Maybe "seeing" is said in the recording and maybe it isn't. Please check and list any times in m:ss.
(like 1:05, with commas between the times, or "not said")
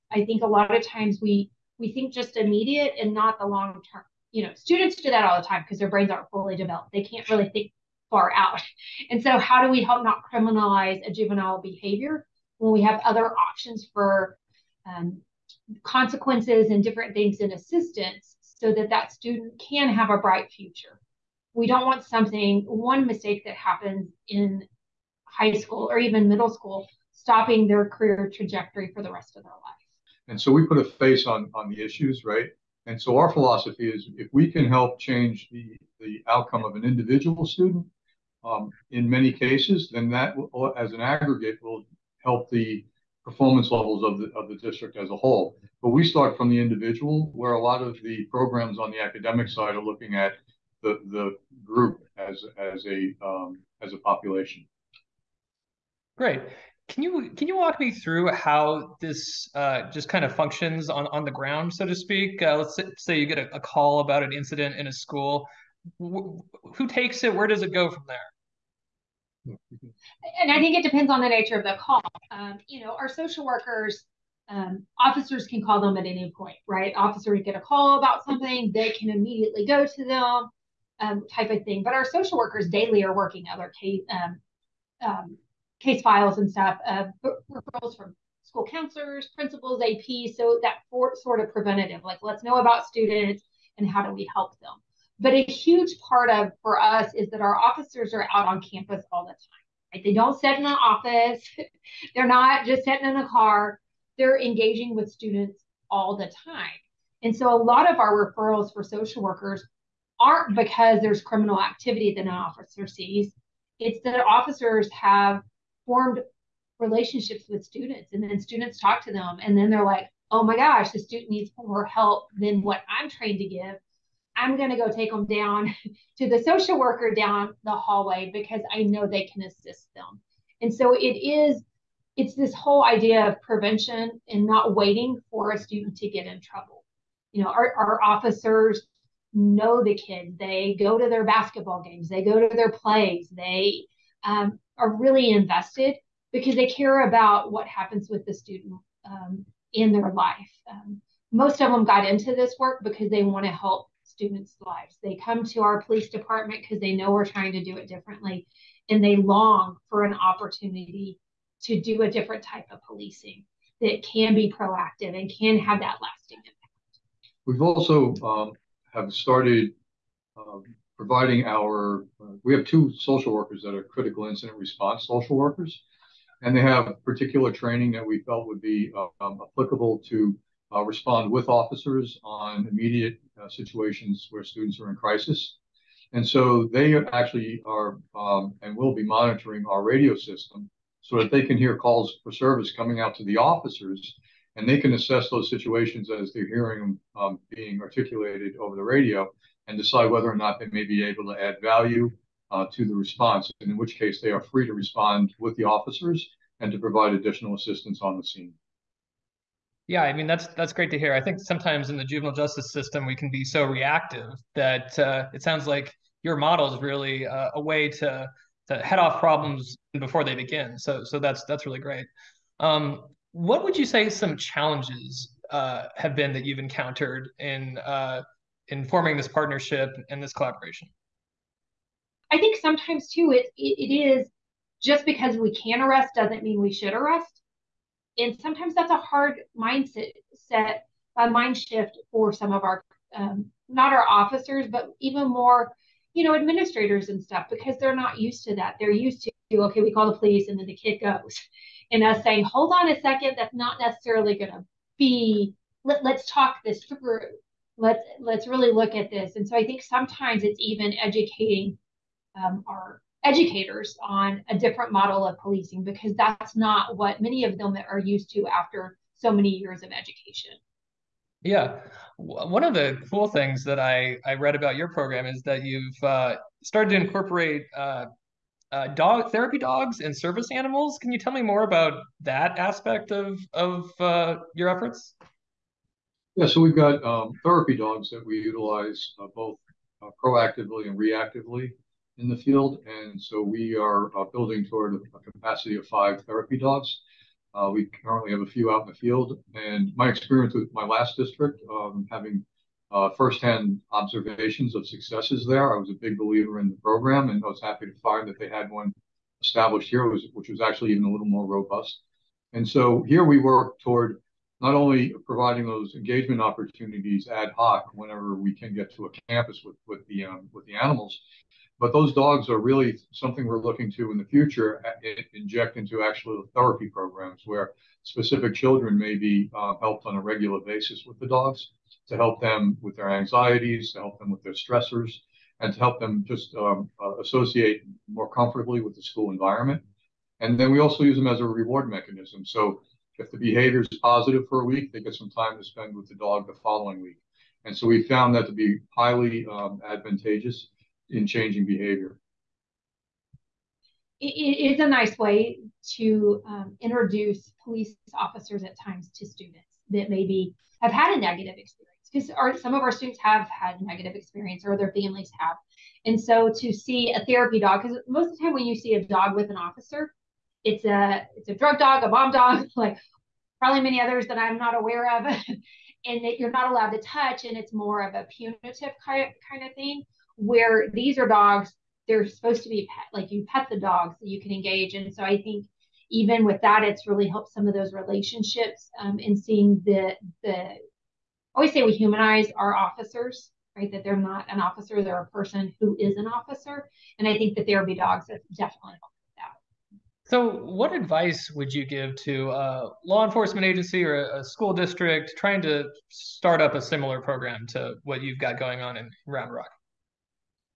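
6:29.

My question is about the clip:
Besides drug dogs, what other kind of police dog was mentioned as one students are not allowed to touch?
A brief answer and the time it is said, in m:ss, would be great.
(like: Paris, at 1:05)
bomb dog, at 6:12.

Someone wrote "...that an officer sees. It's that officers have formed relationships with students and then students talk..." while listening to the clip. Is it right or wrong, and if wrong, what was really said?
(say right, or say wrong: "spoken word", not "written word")
right.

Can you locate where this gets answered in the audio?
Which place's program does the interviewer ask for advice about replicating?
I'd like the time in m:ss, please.
6:49.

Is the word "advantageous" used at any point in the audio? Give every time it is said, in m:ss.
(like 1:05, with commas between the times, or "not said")
5:49.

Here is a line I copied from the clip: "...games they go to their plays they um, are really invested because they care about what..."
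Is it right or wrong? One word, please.
right.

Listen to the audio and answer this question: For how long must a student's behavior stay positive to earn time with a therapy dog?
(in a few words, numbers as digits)
a week.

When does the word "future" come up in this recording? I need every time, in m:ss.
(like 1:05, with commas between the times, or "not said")
0:20, 5:24.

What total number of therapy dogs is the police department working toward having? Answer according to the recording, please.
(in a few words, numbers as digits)
5.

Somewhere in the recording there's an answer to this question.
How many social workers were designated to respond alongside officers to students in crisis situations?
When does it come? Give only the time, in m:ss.
2:52.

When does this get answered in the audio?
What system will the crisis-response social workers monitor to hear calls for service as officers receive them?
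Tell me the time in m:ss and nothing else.
3:09.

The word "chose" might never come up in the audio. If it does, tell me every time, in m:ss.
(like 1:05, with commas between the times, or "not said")
not said.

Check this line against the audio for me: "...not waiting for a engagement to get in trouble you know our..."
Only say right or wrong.
wrong.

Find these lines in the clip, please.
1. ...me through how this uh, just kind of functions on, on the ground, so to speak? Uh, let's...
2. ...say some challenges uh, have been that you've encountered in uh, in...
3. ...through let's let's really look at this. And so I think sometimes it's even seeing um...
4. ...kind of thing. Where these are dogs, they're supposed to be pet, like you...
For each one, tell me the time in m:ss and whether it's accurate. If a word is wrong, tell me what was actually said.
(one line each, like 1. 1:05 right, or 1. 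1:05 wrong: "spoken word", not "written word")
1. 0:57 right
2. 3:43 right
3. 4:16 wrong: "educating", not "seeing"
4. 6:19 right.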